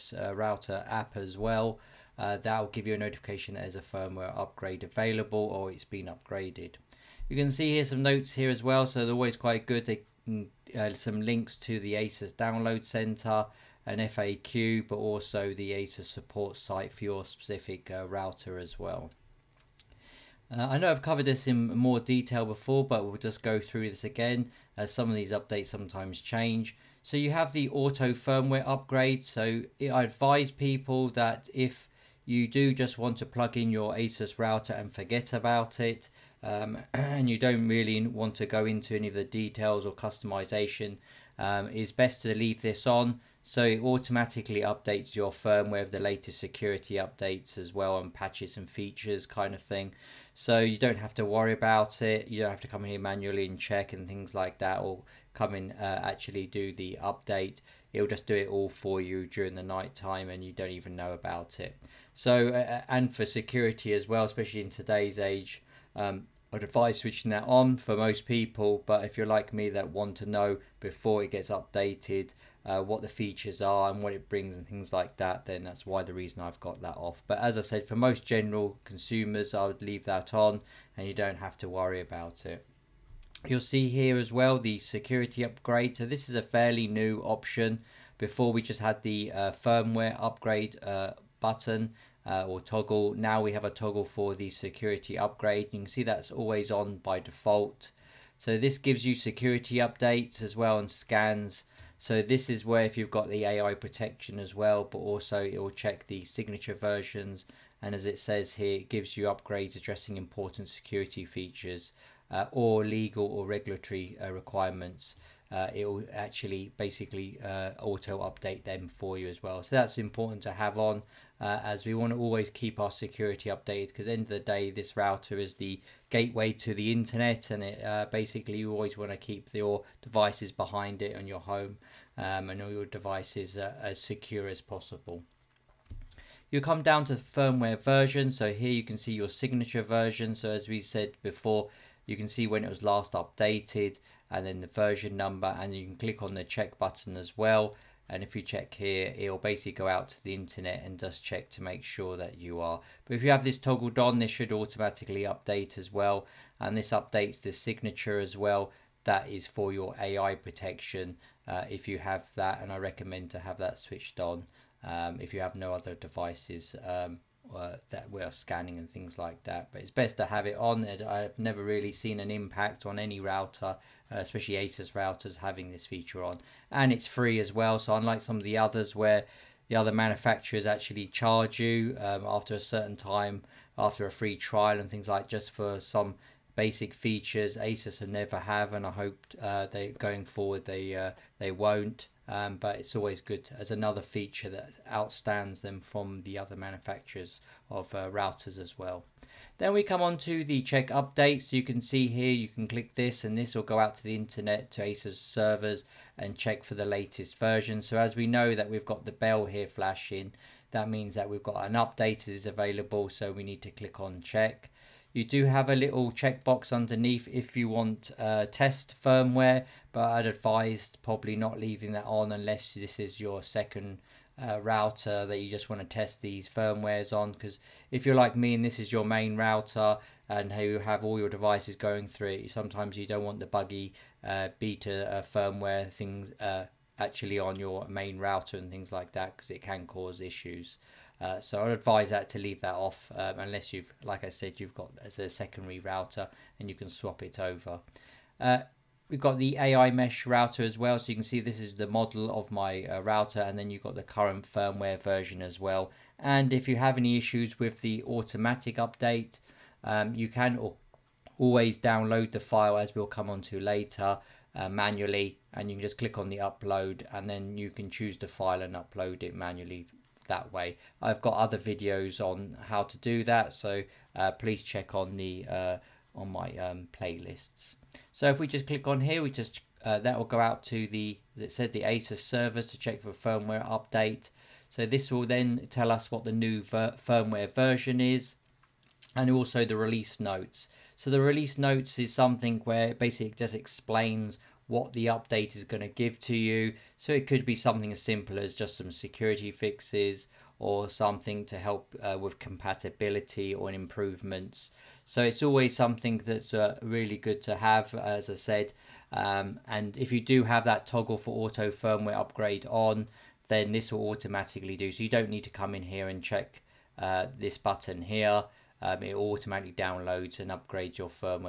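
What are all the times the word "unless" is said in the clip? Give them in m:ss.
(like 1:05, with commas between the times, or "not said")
3:42, 4:03.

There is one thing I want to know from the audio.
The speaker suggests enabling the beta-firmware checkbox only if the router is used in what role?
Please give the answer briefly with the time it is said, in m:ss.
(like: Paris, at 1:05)
secondary router, at 4:05.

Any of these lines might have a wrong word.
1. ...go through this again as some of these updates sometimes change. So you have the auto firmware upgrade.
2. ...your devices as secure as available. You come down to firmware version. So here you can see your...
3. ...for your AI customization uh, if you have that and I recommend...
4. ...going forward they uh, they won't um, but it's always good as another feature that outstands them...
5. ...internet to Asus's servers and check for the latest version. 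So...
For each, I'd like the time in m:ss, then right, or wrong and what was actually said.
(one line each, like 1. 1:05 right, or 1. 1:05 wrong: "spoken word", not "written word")
1. 0:23 right
2. 2:12 wrong: "possible", not "available"
3. 2:39 wrong: "protection", not "customization"
4. 3:09 right
5. 3:24 right.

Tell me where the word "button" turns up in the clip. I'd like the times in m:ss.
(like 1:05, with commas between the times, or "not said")
1:31, 2:26, 5:17.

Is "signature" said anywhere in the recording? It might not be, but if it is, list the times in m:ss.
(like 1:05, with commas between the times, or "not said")
1:46, 2:19, 2:37.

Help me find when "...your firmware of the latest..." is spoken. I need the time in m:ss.
0:45.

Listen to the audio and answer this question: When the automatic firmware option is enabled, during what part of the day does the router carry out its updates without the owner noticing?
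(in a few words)
night time.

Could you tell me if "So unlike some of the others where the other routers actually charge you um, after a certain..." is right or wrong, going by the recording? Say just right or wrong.
wrong.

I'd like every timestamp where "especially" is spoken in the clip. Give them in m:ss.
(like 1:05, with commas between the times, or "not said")
1:04, 2:54.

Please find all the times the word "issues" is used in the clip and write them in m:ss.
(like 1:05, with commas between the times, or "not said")
4:00, 4:17.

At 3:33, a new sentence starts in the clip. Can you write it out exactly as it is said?
So we need to click on check.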